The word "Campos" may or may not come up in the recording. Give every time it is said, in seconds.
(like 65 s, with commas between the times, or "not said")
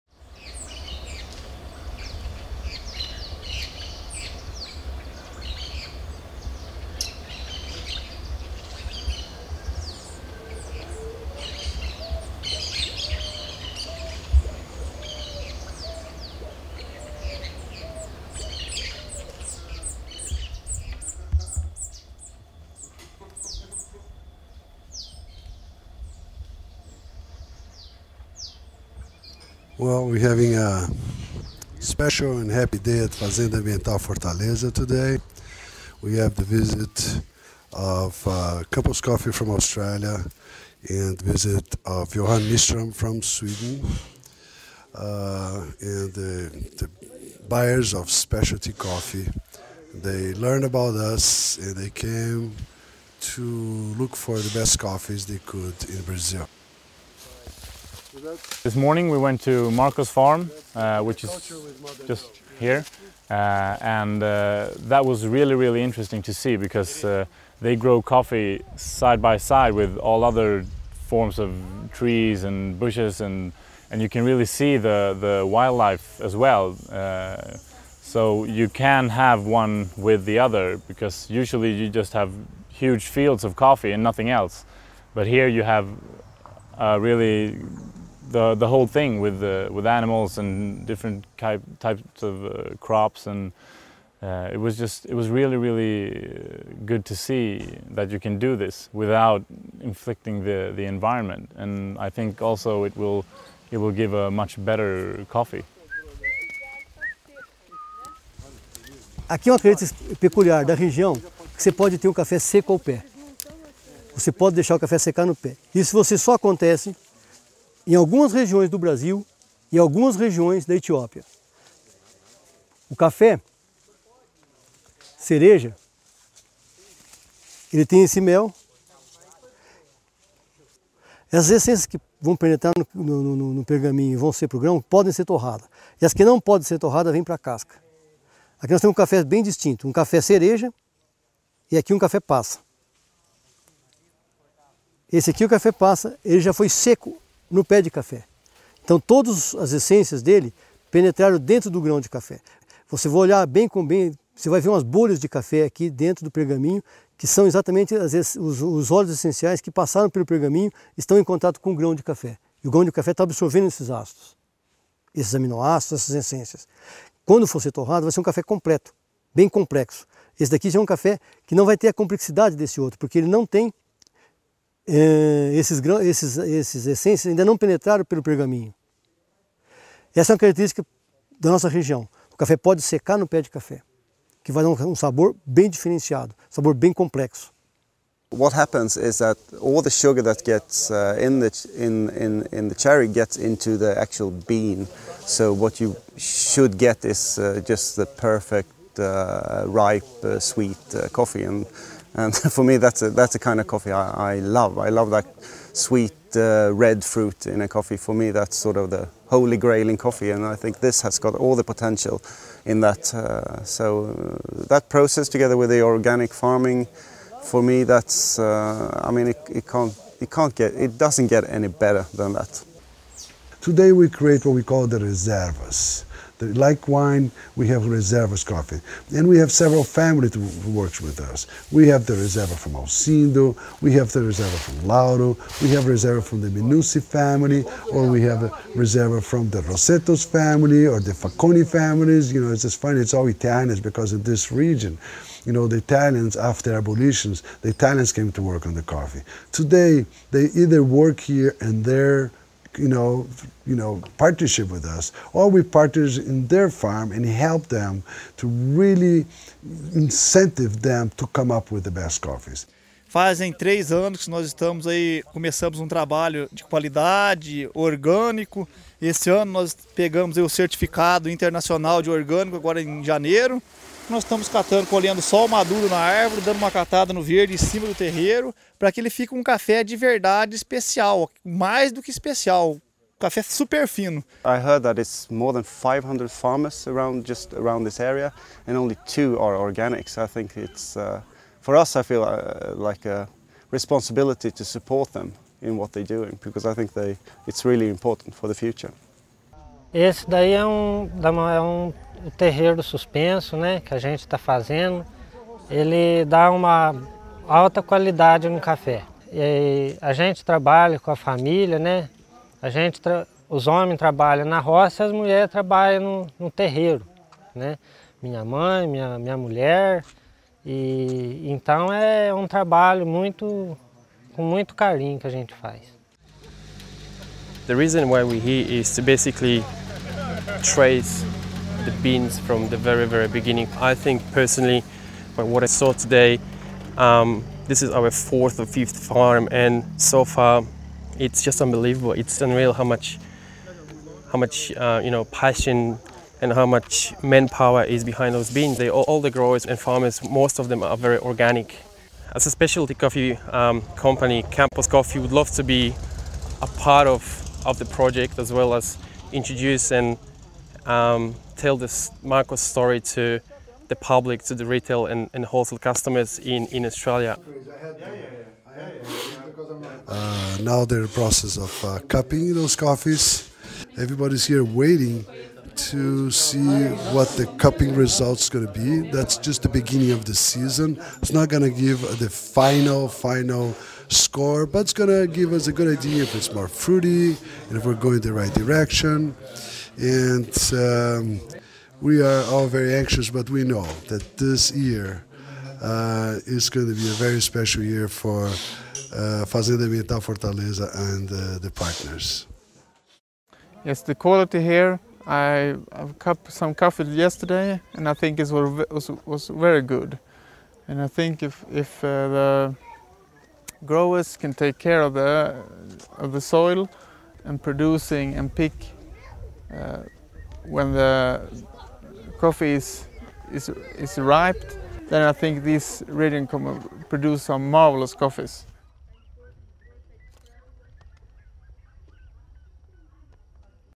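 38 s, 354 s.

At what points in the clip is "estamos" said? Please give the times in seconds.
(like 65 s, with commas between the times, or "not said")
264 s, 274 s.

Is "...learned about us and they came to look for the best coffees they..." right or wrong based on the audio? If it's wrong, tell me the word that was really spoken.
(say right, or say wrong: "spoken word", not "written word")
right.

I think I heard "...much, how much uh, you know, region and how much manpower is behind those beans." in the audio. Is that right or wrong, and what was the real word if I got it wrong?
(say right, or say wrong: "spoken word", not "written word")
wrong: "passion", not "region".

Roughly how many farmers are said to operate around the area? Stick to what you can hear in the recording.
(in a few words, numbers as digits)
500.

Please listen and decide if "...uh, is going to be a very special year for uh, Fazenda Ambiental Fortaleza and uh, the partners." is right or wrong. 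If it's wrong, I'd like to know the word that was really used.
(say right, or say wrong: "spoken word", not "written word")
right.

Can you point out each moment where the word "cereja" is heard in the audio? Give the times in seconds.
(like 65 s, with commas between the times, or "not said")
125 s, 140 s.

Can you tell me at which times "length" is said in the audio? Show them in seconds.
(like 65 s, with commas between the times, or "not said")
not said.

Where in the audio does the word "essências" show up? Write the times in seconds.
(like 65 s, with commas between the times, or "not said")
131 s, 149 s, 166 s, 176 s.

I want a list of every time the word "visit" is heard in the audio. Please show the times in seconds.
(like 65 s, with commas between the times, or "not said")
36 s, 41 s.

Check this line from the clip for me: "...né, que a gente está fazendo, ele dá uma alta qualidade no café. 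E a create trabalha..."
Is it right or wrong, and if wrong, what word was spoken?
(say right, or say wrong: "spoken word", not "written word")
wrong: "gente", not "create".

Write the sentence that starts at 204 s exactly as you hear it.
I love that sweet uh, red fruit in a coffee.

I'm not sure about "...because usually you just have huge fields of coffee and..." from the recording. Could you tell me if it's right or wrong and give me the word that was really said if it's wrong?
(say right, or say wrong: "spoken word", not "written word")
right.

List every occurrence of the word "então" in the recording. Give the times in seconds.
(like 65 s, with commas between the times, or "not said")
148 s, 321 s.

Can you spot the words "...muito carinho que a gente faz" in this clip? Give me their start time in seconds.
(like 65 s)
324 s.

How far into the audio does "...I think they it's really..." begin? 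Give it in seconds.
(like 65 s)
296 s.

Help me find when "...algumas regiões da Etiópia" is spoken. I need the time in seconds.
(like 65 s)
119 s.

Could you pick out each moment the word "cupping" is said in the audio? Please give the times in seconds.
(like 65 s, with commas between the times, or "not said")
372 s, 377 s.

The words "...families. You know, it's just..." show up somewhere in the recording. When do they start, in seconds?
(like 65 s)
241 s.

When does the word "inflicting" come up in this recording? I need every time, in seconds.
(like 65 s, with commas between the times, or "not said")
99 s.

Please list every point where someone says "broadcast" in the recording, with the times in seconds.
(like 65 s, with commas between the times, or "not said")
not said.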